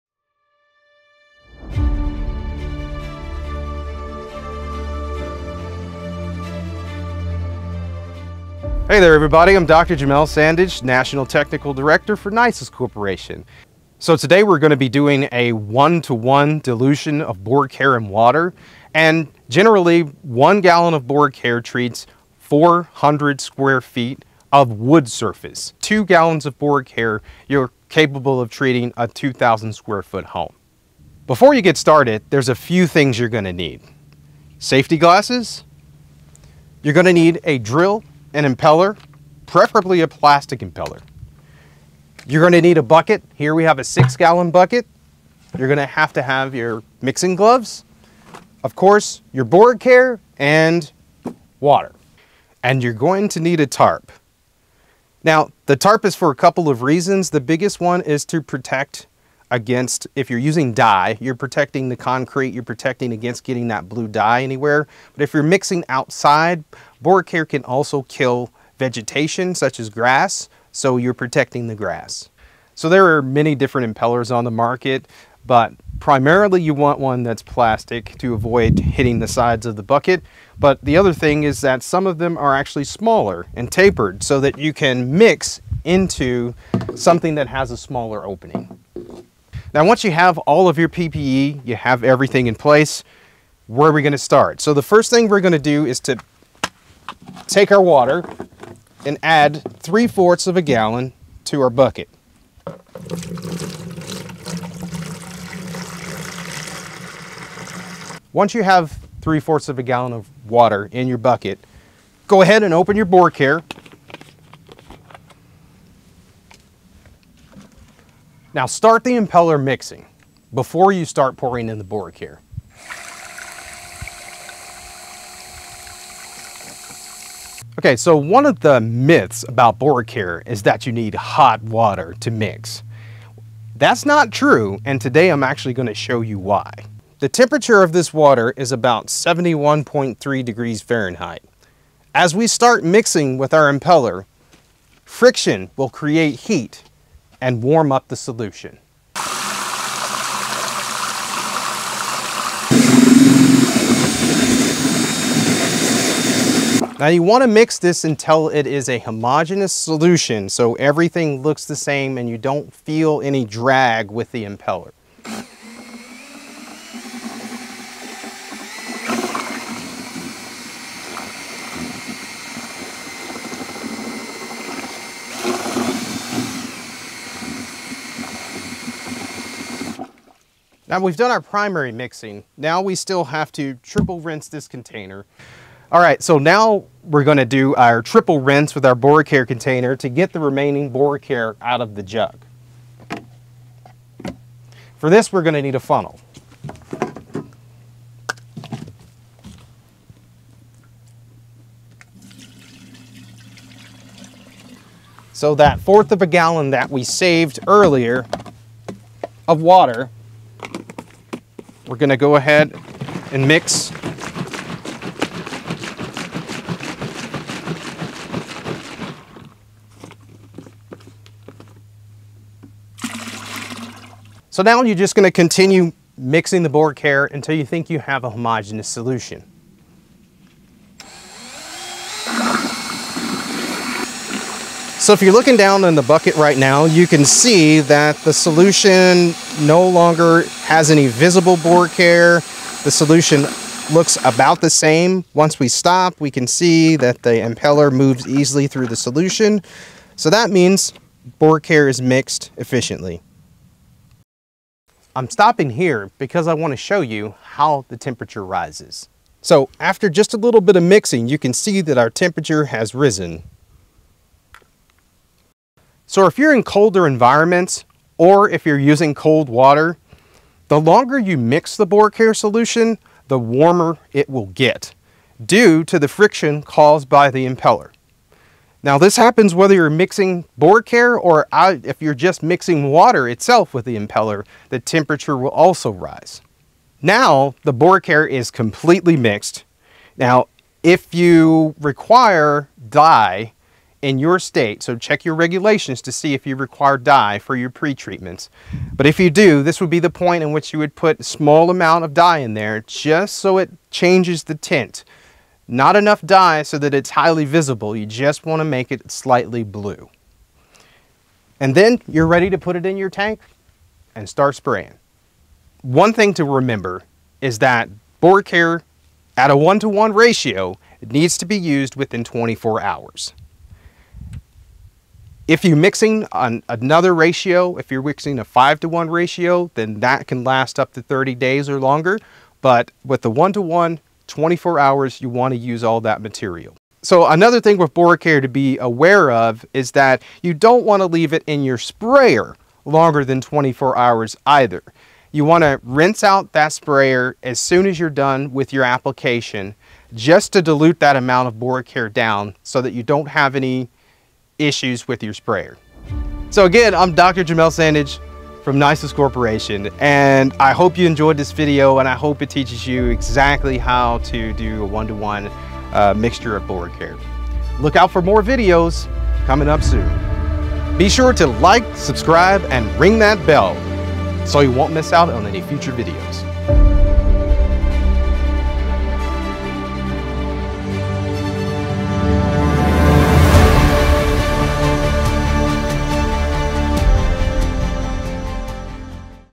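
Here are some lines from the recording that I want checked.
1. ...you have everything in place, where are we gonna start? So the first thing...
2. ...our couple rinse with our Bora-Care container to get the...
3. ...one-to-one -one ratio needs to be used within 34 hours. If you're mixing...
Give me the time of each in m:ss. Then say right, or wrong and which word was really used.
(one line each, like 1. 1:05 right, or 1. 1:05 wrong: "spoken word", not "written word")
1. 1:31 right
2. 3:07 wrong: "triple", not "couple"
3. 5:19 wrong: "24", not "34".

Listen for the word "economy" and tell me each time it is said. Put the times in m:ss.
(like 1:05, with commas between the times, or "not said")
not said.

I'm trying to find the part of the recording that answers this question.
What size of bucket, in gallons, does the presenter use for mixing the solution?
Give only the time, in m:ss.
0:43.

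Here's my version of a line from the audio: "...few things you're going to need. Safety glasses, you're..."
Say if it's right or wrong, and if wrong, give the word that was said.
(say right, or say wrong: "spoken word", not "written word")
right.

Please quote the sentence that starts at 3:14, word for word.
For this, we're gonna need a funnel.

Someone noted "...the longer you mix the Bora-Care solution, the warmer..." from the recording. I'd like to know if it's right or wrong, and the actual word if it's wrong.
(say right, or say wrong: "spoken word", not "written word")
right.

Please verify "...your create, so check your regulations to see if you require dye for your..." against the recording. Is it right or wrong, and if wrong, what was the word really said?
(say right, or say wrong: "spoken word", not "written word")
wrong: "state", not "create".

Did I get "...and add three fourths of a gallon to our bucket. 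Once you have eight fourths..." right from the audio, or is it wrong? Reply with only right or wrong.
wrong.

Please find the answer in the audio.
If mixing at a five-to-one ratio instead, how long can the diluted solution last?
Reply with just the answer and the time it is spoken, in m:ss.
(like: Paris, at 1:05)
30 days, at 5:31.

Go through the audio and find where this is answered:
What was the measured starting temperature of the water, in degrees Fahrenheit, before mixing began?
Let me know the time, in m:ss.
2:19.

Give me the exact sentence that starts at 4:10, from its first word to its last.
So that means Bora-Care is mixed efficiently.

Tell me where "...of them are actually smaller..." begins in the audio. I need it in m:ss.
1:22.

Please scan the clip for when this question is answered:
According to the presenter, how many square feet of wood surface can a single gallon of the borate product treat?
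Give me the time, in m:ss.
0:22.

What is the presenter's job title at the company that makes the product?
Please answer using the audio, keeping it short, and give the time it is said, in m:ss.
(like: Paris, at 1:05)
National Technical Director, at 0:10.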